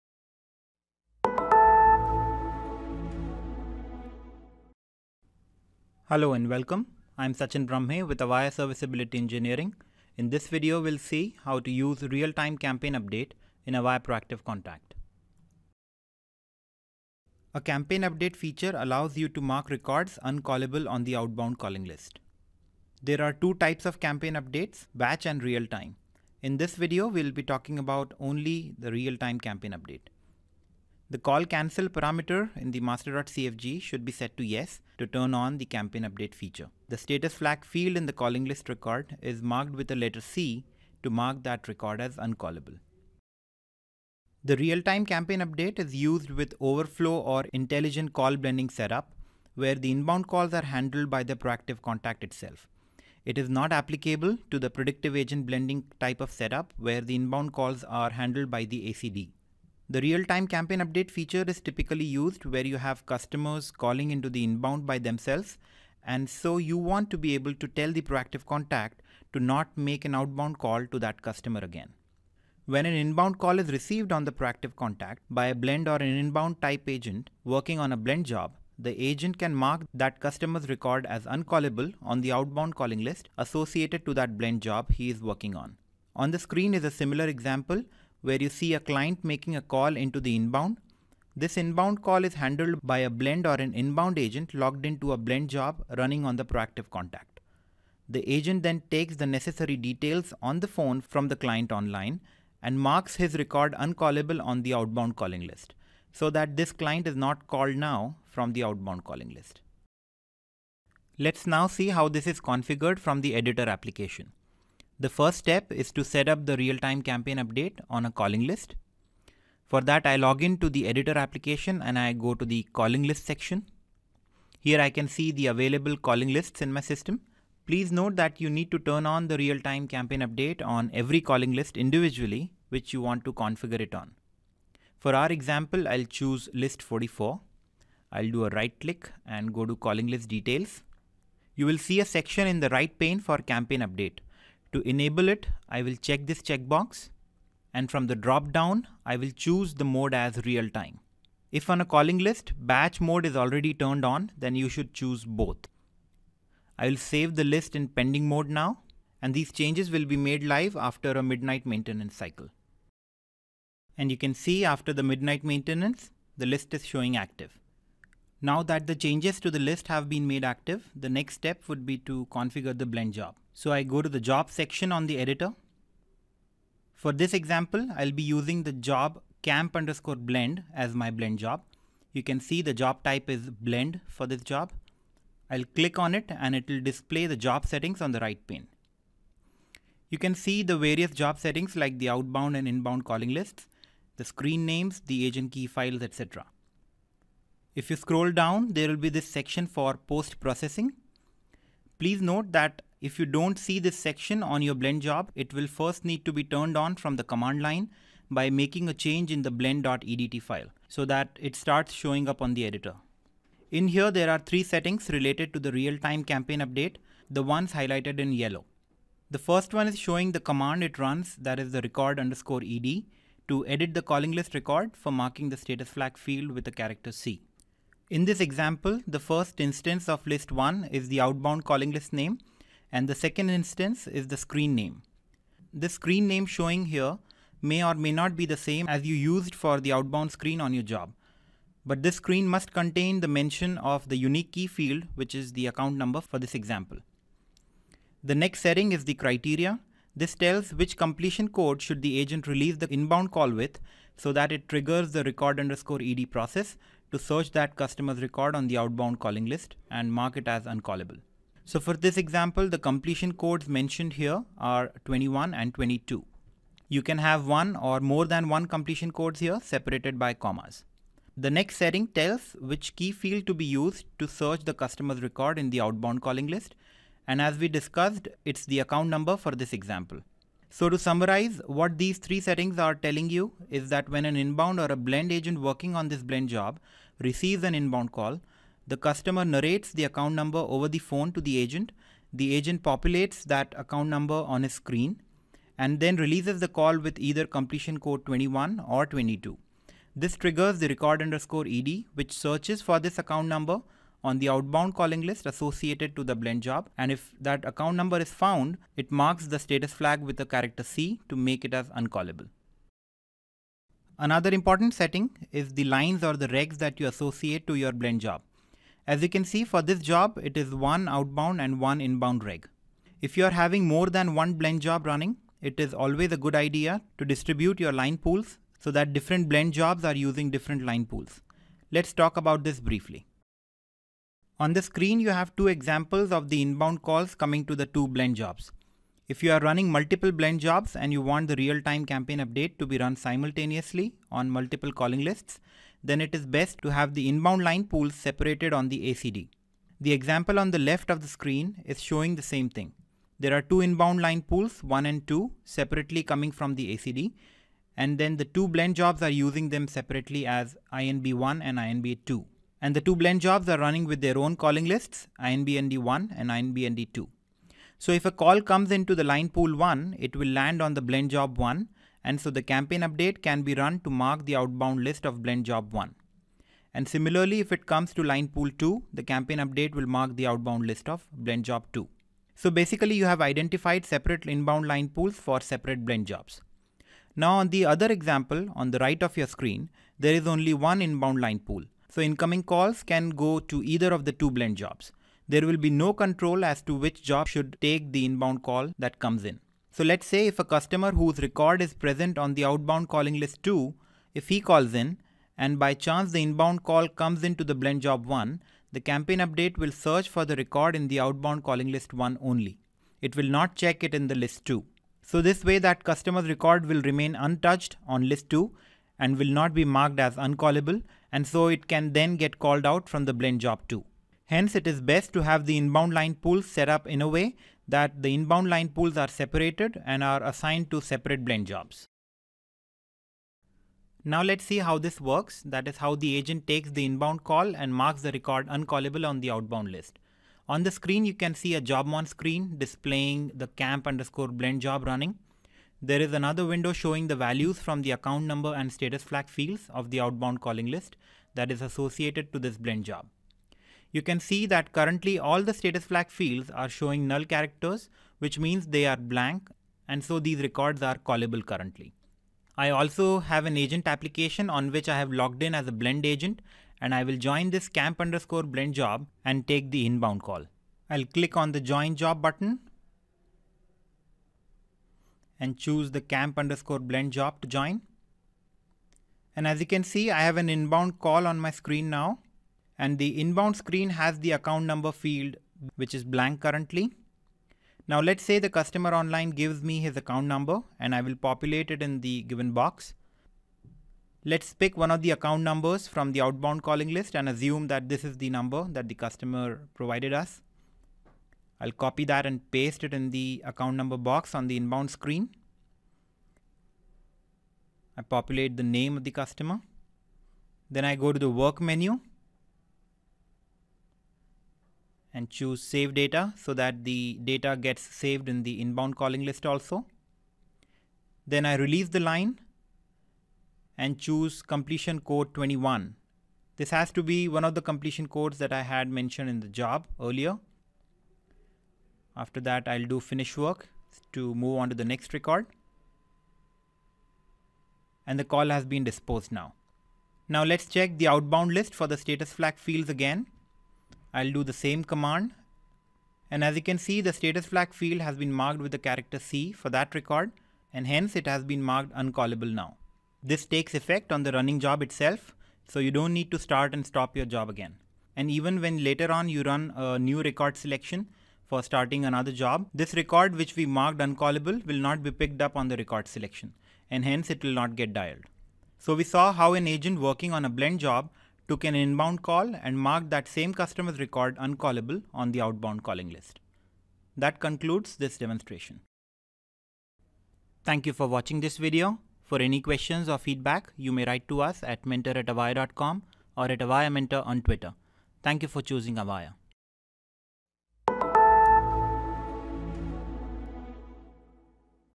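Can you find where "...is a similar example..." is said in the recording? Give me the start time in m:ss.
1:26.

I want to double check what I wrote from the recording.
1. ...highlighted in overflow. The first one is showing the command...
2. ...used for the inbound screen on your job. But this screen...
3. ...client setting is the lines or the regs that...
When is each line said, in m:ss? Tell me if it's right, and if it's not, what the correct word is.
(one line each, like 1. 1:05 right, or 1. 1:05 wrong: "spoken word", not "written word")
1. 3:37 wrong: "yellow", not "overflow"
2. 3:59 wrong: "outbound", not "inbound"
3. 5:14 wrong: "important", not "client".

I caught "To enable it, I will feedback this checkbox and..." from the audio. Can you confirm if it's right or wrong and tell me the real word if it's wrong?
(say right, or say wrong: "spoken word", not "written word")
wrong: "check", not "feedback".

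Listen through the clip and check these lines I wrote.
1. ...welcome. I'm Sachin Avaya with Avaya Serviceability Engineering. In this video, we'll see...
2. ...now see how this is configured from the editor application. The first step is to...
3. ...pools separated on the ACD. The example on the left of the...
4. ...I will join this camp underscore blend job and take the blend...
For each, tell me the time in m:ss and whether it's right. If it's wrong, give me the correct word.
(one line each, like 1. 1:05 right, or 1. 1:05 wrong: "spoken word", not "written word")
1. 0:06 wrong: "Brahme", not "Avaya"
2. 1:51 right
3. 5:47 right
4. 7:47 wrong: "inbound", not "blend".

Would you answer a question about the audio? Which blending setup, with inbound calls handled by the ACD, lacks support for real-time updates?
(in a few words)
predictive agent blending.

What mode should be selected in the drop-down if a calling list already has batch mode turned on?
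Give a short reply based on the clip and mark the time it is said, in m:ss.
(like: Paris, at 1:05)
both, at 2:35.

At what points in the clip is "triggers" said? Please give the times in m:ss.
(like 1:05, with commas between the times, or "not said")
4:14, 5:00.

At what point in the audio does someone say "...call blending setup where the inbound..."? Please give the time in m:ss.
0:48.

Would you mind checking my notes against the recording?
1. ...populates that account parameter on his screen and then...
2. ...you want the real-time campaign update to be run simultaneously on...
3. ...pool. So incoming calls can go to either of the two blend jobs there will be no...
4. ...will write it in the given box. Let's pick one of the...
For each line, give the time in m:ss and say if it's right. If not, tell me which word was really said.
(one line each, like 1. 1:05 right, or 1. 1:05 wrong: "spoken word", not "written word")
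1. 4:52 wrong: "number", not "parameter"
2. 5:41 right
3. 6:31 right
4. 8:11 wrong: "populate", not "write".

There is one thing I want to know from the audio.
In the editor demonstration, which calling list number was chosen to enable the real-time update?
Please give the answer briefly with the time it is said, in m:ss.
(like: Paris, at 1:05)
44, at 2:16.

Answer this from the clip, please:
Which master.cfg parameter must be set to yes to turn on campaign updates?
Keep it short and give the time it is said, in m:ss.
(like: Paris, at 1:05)
call cancel, at 0:31.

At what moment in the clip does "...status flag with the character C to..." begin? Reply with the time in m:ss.
5:09.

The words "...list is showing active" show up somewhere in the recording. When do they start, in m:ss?
2:46.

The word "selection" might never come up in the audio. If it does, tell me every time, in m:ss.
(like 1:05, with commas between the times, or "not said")
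9:20, 9:26.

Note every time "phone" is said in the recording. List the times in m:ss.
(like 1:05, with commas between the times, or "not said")
1:40, 4:50.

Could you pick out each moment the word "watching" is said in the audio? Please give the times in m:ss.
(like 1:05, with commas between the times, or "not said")
9:41.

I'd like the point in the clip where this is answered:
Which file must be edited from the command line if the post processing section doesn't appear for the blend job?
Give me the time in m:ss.
3:29.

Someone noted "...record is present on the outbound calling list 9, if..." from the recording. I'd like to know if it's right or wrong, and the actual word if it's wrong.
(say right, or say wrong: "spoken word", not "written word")
wrong: "2", not "9".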